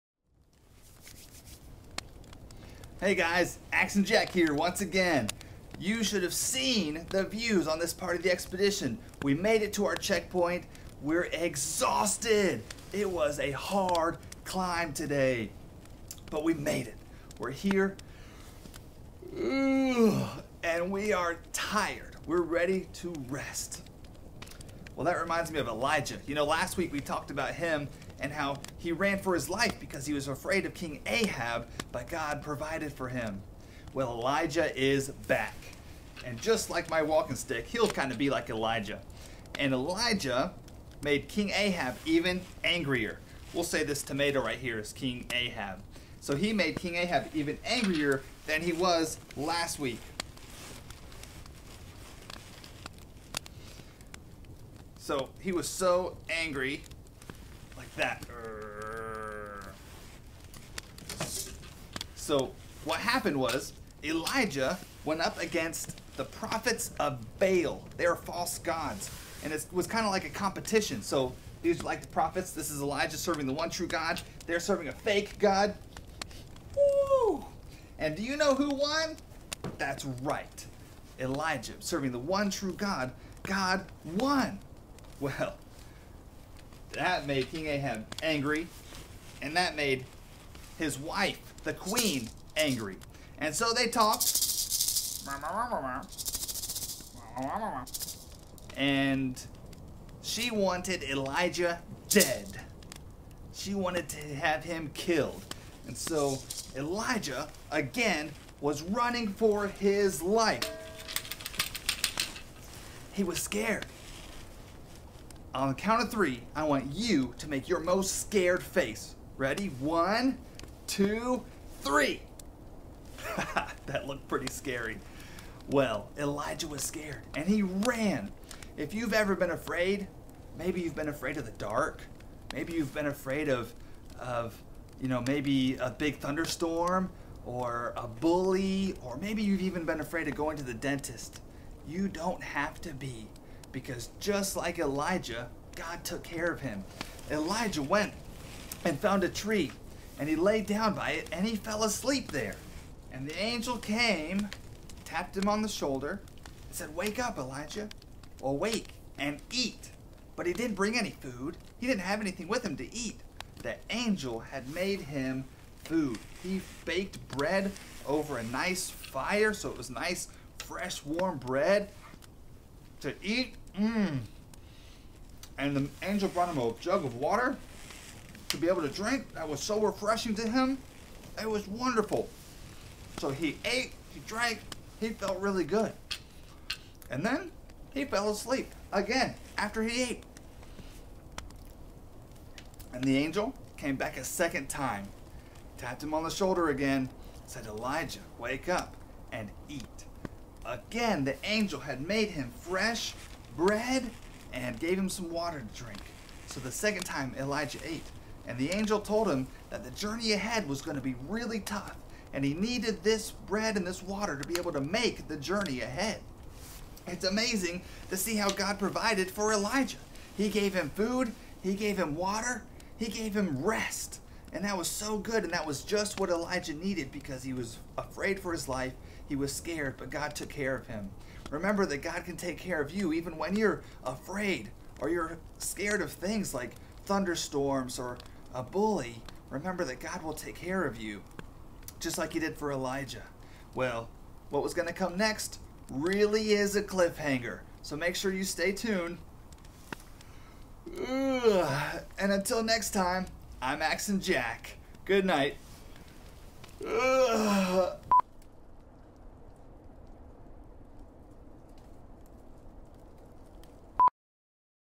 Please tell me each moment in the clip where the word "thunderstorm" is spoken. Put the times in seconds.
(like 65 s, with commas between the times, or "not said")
136 s, 237 s.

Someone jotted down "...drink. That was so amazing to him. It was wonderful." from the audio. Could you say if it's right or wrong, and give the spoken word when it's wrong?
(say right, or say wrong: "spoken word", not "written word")
wrong: "refreshing", not "amazing".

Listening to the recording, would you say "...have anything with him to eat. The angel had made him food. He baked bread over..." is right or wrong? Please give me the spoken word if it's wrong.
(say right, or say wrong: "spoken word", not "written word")
right.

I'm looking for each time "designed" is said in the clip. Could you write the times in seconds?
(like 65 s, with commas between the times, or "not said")
not said.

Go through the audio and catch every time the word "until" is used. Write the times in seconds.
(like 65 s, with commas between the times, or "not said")
252 s.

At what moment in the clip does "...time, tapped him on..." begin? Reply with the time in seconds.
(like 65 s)
194 s.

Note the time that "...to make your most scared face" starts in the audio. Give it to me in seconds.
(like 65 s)
117 s.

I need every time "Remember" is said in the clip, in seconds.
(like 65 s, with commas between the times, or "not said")
231 s, 239 s.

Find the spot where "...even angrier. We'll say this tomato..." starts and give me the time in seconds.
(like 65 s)
42 s.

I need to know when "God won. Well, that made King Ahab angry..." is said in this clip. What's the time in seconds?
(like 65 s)
83 s.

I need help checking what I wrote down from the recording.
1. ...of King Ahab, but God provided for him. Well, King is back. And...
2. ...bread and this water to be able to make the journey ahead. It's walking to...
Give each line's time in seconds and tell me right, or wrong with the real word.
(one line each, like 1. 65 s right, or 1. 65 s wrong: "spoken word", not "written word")
1. 30 s wrong: "Elijah", not "King"
2. 213 s wrong: "amazing", not "walking".